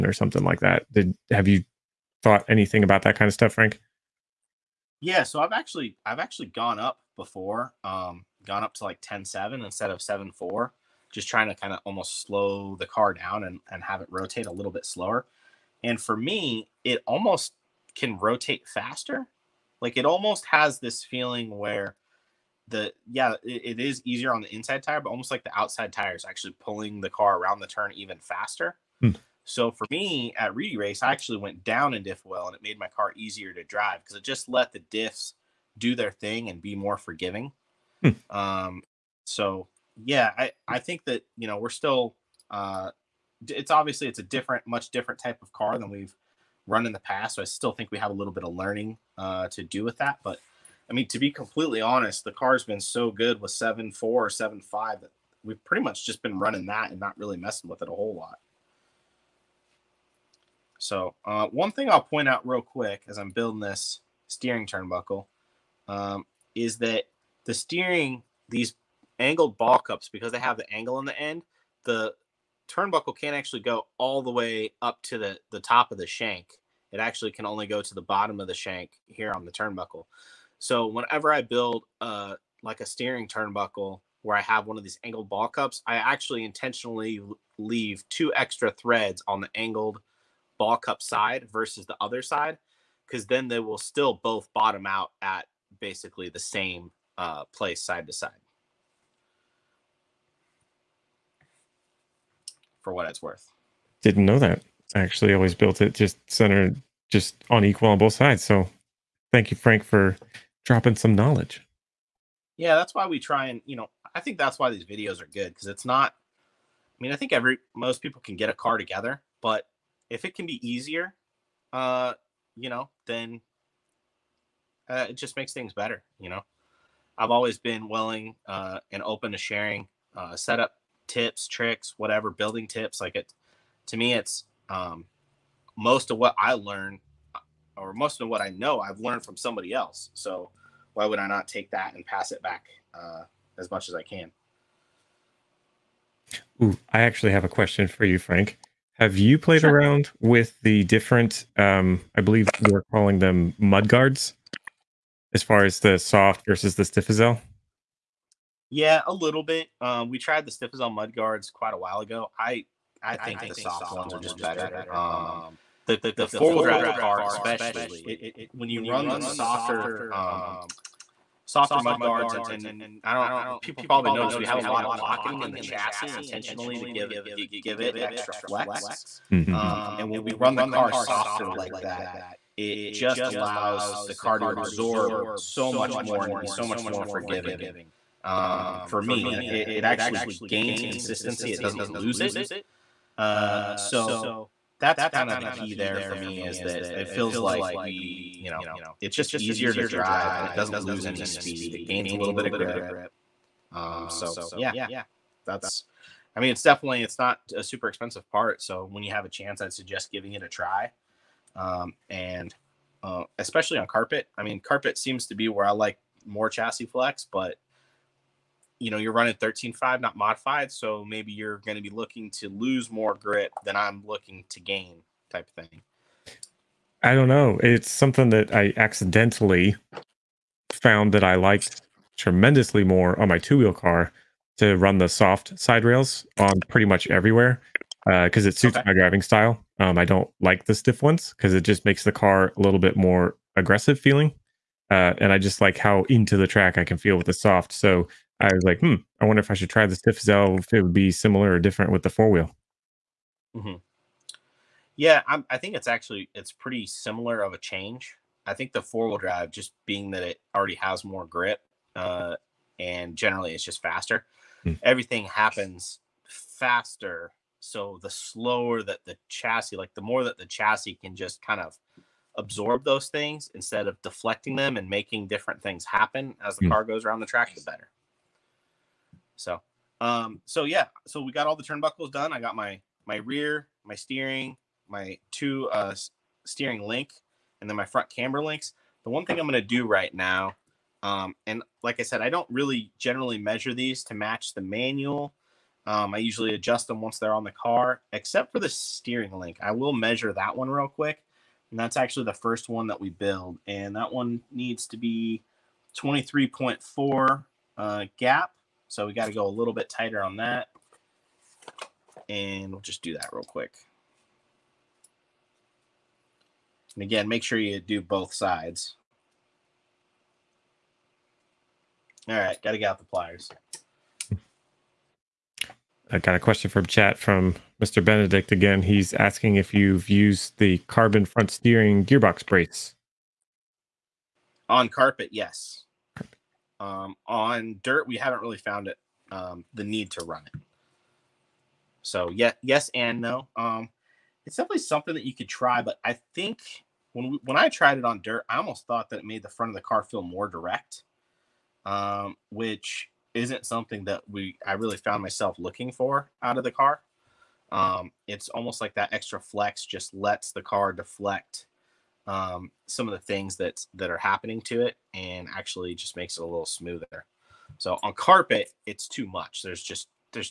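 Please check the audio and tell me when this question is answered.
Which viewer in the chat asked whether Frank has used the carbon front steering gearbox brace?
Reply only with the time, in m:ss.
5:27.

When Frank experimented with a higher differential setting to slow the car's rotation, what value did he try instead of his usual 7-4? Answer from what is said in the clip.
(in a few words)
10-7.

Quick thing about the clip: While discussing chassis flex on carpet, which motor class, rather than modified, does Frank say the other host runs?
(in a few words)
13.5.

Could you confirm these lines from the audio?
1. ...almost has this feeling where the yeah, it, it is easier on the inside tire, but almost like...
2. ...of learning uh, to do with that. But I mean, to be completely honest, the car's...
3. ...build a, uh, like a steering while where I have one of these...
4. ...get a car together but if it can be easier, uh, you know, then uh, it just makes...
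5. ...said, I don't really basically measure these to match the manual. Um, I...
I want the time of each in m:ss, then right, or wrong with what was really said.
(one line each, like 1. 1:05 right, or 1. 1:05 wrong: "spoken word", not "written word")
1. 0:20 right
2. 0:48 right
3. 1:21 wrong: "turnbuckle", not "while"
4. 1:58 right
5. 4:52 wrong: "generally", not "basically".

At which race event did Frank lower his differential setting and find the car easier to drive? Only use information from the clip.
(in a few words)
Reedy Race.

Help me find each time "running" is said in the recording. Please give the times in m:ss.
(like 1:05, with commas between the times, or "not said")
0:56, 3:39.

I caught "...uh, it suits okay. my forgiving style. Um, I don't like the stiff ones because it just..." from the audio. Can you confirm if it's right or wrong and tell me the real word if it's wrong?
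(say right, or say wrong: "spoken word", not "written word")
wrong: "driving", not "forgiving".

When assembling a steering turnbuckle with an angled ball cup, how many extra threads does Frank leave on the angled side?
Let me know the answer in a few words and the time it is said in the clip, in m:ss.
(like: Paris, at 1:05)
2, at 1:28.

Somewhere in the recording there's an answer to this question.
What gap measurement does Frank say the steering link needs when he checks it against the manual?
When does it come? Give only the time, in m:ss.
5:05.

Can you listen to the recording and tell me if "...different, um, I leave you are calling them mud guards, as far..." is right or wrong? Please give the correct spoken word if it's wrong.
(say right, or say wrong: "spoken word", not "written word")
wrong: "believe", not "leave".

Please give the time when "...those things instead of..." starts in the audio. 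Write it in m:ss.
4:32.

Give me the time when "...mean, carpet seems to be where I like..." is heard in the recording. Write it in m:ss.
3:34.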